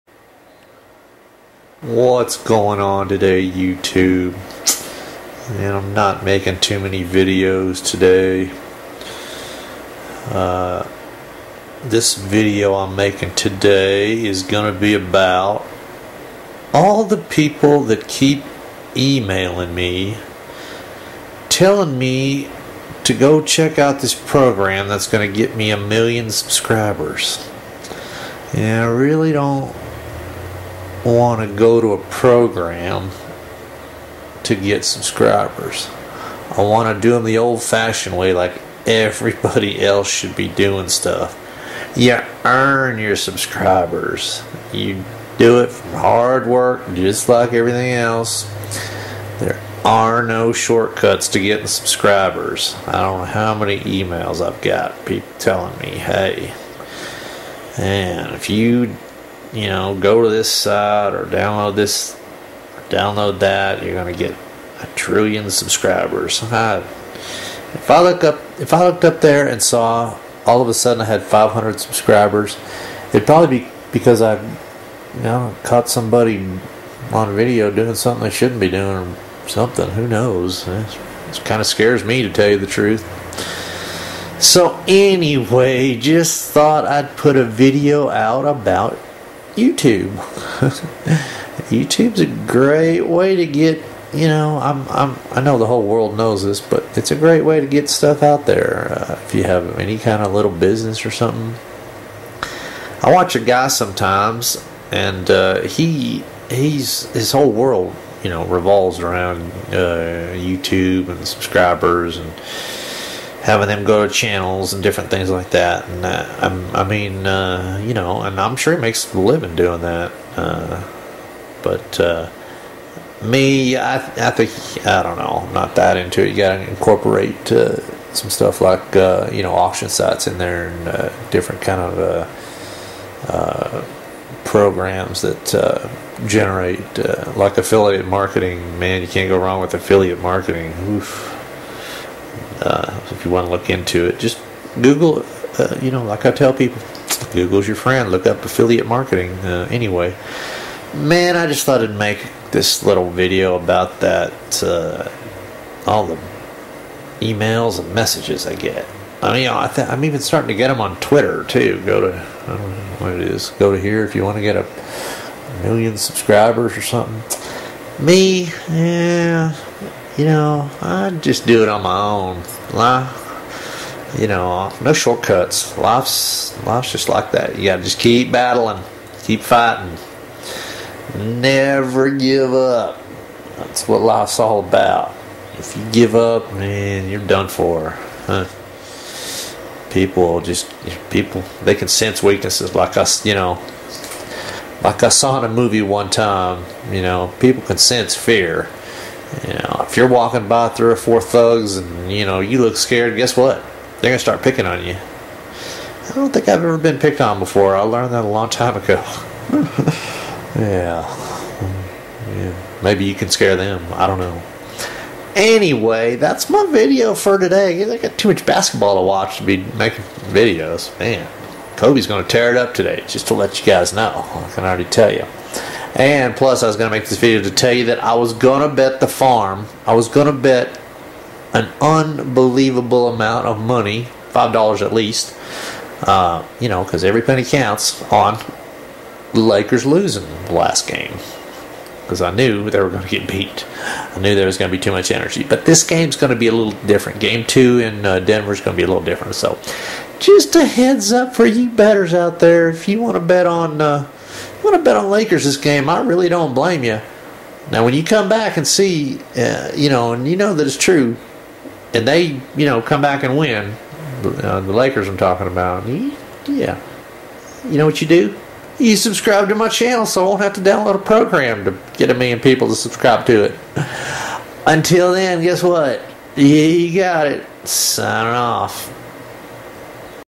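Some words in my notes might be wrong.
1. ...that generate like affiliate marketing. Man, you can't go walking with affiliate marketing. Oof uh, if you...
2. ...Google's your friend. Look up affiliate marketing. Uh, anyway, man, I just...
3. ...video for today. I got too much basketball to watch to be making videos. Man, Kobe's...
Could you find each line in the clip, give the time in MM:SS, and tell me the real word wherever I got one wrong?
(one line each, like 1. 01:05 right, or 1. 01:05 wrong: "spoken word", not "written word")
1. 02:15 wrong: "wrong", not "walking"
2. 02:27 right
3. 03:36 right.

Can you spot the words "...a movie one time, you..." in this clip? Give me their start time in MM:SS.
03:15.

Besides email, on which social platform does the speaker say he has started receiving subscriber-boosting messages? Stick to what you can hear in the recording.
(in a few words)
Twitter.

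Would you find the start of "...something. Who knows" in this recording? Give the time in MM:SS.
01:19.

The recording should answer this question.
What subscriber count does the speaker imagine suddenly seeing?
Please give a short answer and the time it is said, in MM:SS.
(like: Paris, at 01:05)
500, at 01:11.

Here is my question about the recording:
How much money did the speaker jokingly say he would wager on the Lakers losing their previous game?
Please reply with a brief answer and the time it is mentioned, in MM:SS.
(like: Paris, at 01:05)
$5, at 03:54.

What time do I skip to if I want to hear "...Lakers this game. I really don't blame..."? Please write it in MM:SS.
04:15.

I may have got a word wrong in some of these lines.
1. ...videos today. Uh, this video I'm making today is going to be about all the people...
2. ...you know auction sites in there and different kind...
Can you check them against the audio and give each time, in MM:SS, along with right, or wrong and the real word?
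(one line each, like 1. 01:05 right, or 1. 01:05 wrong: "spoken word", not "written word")
1. 00:07 right
2. 02:09 right.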